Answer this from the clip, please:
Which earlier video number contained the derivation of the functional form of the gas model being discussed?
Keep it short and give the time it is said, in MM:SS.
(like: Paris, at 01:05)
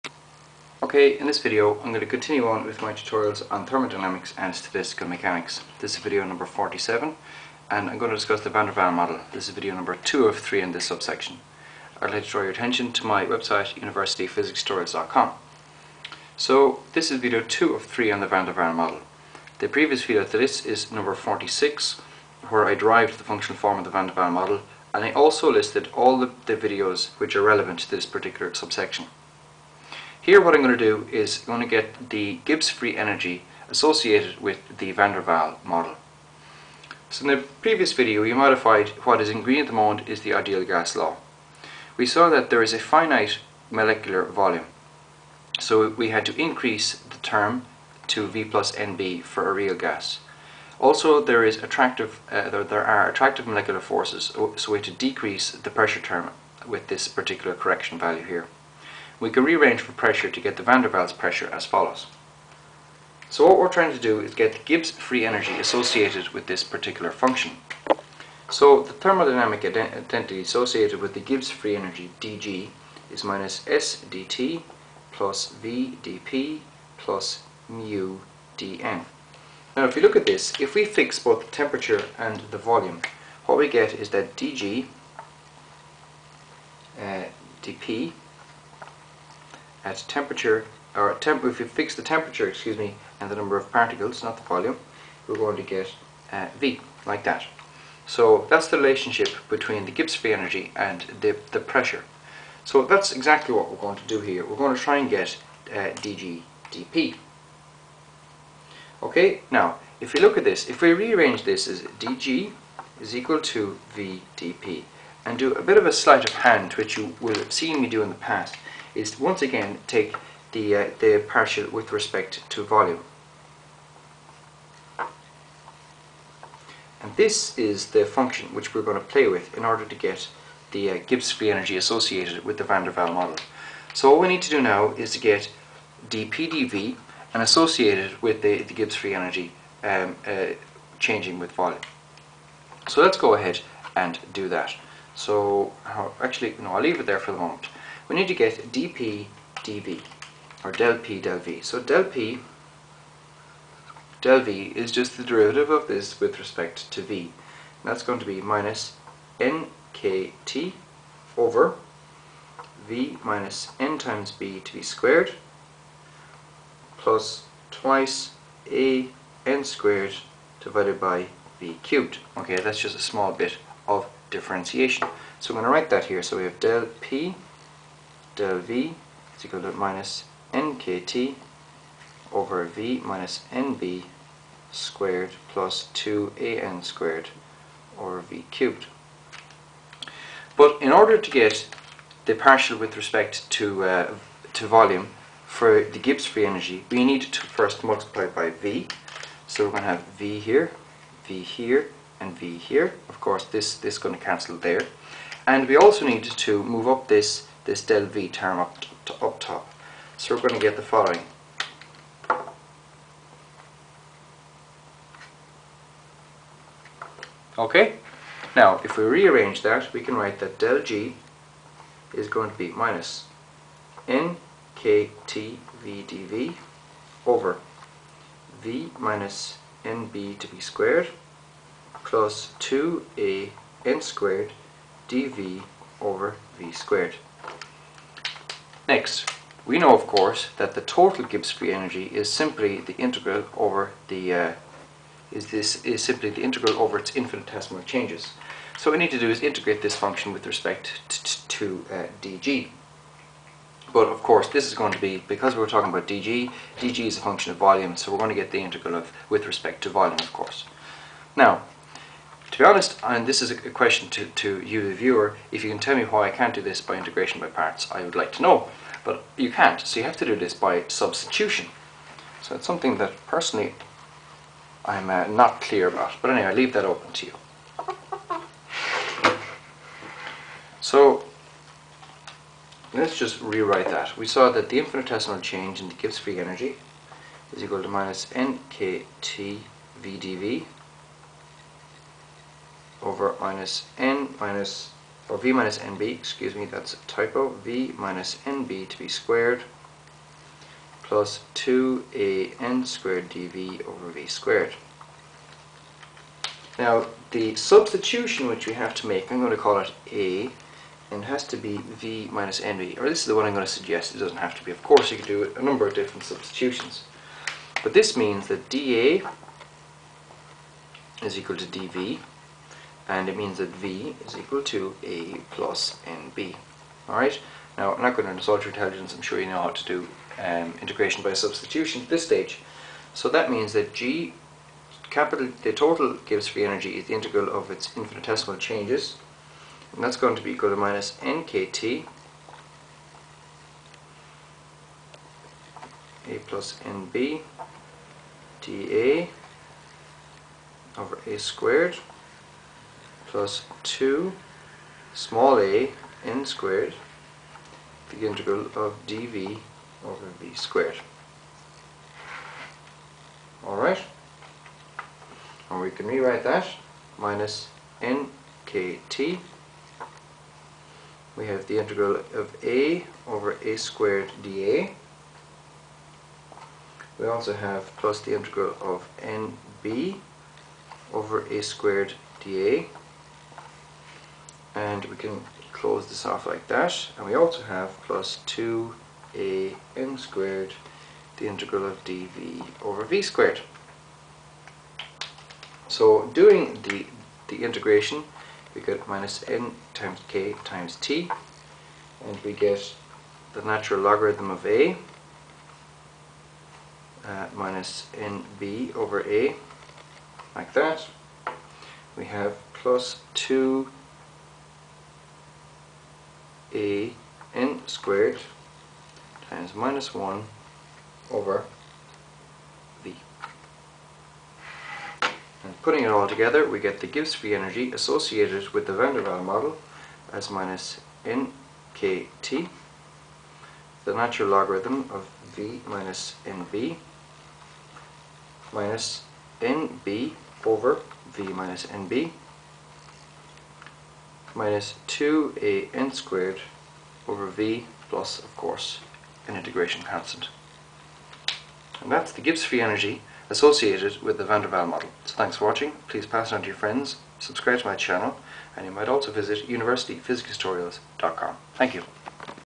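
46, at 00:20.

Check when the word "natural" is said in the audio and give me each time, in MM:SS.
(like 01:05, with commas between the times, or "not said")
06:43, 07:14.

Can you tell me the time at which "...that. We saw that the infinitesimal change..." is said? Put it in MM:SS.
04:43.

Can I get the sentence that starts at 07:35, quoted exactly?
So thanks for watching, please pass it on to your friends, subscribe to my channel, and you might also visit universityphysicstutorials.com.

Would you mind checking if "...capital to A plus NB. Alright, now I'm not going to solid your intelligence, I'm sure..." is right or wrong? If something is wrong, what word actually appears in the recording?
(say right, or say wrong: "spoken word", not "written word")
wrong: "equal", not "capital".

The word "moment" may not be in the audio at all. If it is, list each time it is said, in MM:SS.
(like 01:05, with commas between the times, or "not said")
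00:39, 02:27.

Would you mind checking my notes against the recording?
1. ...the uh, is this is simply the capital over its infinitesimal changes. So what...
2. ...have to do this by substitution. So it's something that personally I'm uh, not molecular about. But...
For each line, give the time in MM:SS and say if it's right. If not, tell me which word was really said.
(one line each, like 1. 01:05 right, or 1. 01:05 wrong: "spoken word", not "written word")
1. 04:04 wrong: "integral", not "capital"
2. 04:30 wrong: "clear", not "molecular".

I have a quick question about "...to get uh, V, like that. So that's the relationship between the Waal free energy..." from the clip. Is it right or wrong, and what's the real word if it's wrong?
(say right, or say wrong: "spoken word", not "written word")
wrong: "Gibbs", not "Waal".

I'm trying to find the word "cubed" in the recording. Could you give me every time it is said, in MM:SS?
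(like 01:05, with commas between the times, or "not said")
02:51, 03:08.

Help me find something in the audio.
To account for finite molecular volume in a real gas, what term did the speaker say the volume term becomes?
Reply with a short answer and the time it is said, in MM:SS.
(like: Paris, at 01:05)
V plus NB, at 00:48.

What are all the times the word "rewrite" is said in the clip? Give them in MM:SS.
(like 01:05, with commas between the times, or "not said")
04:43, 06:06.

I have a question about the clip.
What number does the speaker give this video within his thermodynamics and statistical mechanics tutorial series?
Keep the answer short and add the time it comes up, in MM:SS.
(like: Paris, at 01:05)
47, at 00:06.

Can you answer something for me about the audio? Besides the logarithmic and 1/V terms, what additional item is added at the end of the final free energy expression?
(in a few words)
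An integration constant.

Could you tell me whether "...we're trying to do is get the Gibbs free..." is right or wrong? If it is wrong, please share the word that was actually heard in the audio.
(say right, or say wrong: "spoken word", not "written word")
right.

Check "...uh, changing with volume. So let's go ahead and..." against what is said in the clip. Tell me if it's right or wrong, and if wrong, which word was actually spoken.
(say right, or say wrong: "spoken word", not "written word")
right.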